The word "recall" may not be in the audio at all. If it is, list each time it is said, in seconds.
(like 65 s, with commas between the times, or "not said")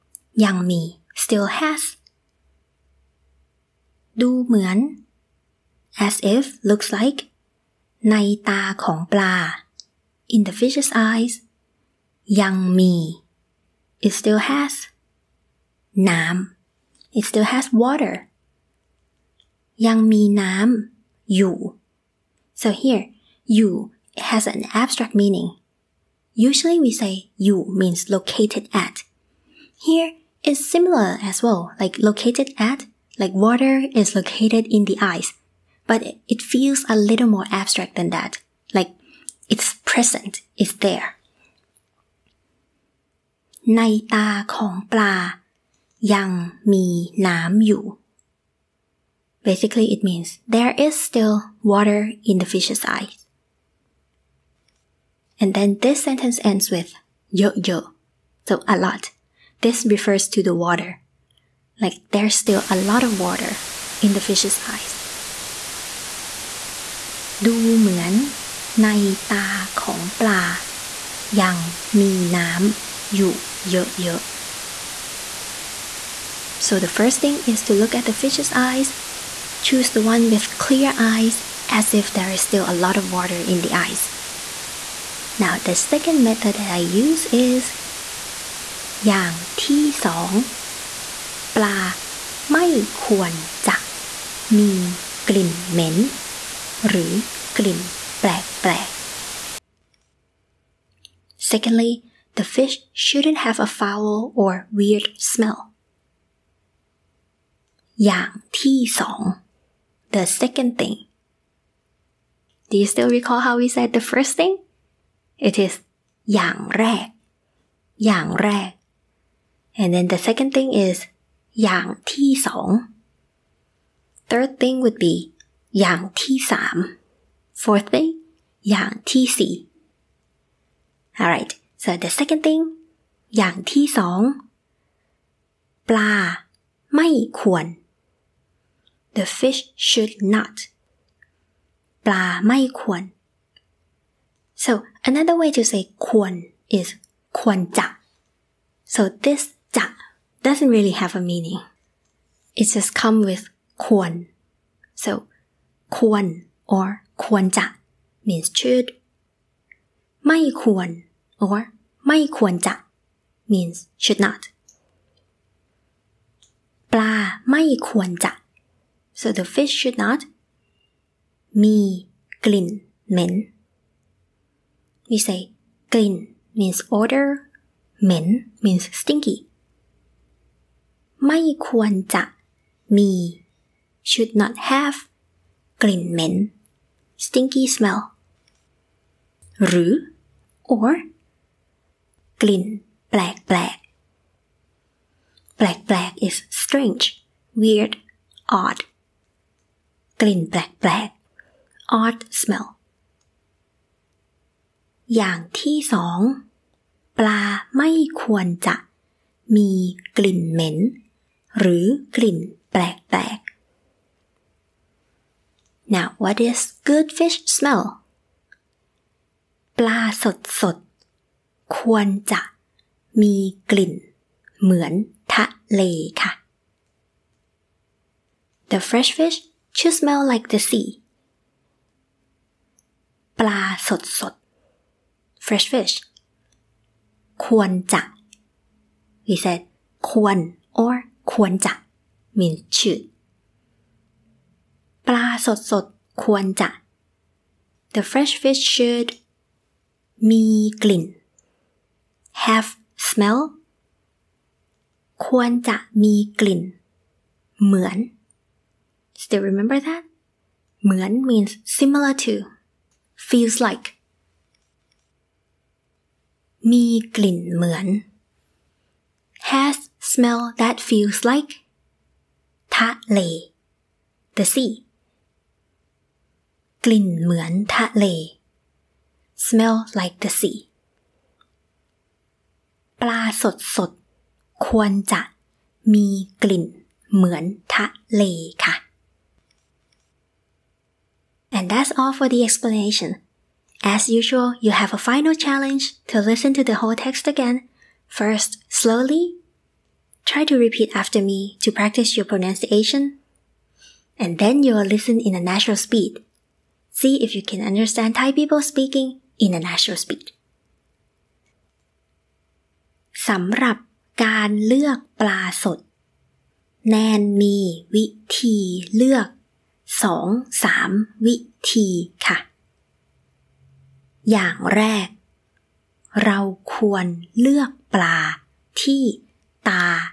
113 s.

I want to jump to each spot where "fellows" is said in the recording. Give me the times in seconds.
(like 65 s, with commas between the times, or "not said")
not said.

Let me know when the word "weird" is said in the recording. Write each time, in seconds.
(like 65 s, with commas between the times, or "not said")
104 s, 197 s.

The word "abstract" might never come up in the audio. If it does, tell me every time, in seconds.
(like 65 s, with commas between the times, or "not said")
24 s, 37 s.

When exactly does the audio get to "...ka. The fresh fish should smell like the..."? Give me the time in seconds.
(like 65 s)
226 s.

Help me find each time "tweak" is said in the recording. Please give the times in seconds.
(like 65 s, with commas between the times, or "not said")
not said.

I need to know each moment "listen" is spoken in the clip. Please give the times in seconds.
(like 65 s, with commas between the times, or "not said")
296 s, 304 s.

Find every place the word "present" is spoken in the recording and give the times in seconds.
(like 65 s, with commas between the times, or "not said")
39 s.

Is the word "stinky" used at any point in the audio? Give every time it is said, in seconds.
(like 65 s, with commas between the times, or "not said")
178 s, 187 s.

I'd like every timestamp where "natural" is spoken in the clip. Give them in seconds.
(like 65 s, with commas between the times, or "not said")
305 s, 309 s.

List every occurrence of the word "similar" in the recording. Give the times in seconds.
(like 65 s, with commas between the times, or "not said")
30 s, 261 s.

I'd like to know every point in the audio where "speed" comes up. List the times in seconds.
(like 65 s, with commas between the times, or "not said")
305 s, 310 s.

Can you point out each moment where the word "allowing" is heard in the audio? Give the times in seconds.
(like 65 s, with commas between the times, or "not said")
not said.